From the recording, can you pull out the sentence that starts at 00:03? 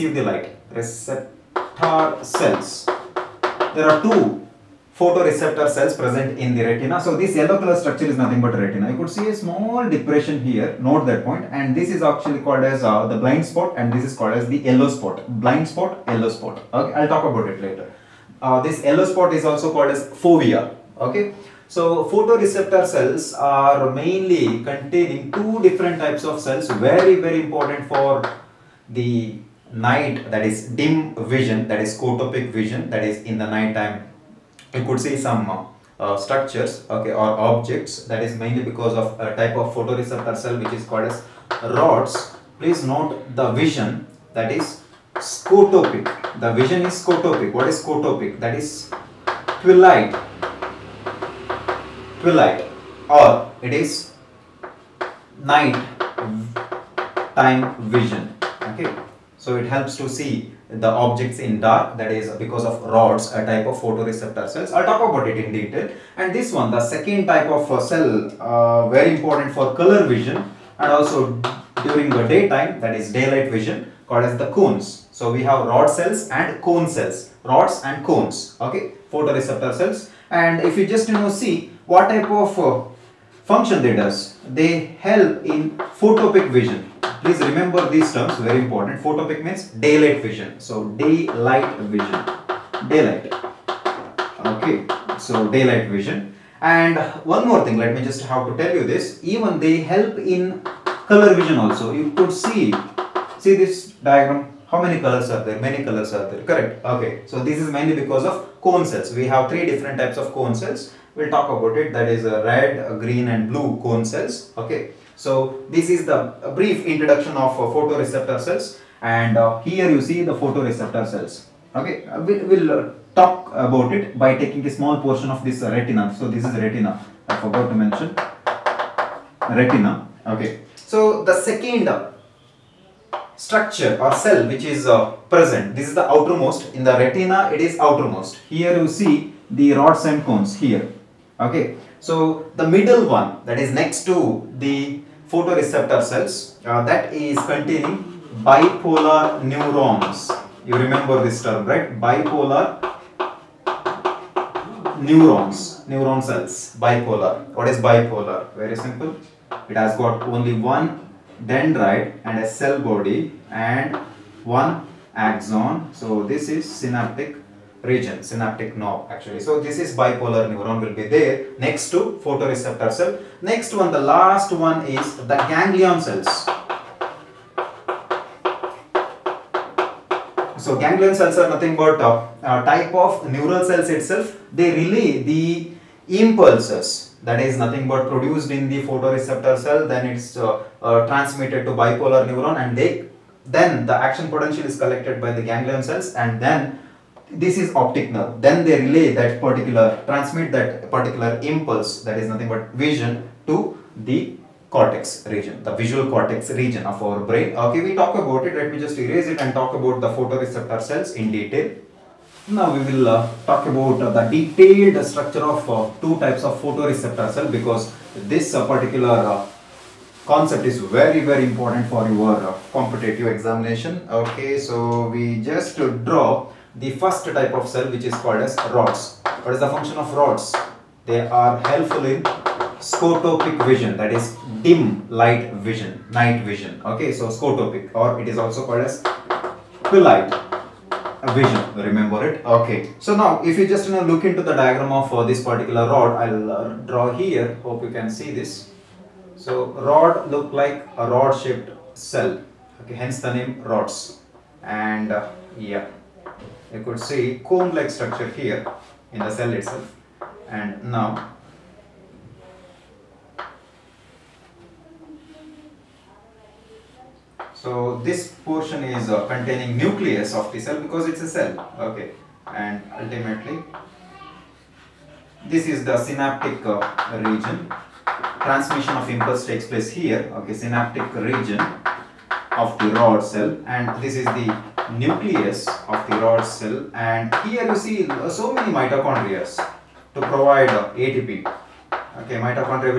There are two photoreceptor cells present in the retina.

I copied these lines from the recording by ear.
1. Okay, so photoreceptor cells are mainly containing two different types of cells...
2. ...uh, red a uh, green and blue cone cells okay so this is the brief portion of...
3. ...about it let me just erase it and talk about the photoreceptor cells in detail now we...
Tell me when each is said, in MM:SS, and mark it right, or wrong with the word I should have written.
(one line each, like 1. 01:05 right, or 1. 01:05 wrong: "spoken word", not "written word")
1. 00:20 right
2. 01:52 wrong: "introduction", not "portion"
3. 03:28 right.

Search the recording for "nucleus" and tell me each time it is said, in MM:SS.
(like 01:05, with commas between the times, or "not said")
04:29, 04:44.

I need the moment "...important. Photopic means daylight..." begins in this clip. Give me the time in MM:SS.
01:28.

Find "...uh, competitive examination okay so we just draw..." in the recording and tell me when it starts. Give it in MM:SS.
03:42.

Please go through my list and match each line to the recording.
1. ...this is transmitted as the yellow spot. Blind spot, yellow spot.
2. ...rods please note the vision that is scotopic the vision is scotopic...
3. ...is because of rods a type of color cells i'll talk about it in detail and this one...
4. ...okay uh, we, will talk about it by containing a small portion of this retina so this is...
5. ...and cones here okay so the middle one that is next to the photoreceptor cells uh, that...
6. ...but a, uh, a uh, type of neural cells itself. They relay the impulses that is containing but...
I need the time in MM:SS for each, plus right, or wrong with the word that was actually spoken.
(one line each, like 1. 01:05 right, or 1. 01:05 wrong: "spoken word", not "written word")
1. 00:13 wrong: "called", not "transmitted"
2. 00:41 right
3. 01:02 wrong: "photoreceptor", not "color"
4. 02:01 wrong: "taking", not "containing"
5. 02:20 right
6. 03:01 wrong: "nothing", not "containing".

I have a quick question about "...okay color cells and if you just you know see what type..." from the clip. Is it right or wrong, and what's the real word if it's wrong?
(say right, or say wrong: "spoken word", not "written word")
wrong: "photoreceptor", not "color".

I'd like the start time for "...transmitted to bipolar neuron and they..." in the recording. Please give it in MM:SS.
03:11.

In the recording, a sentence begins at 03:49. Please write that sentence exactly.
What is the function of rods?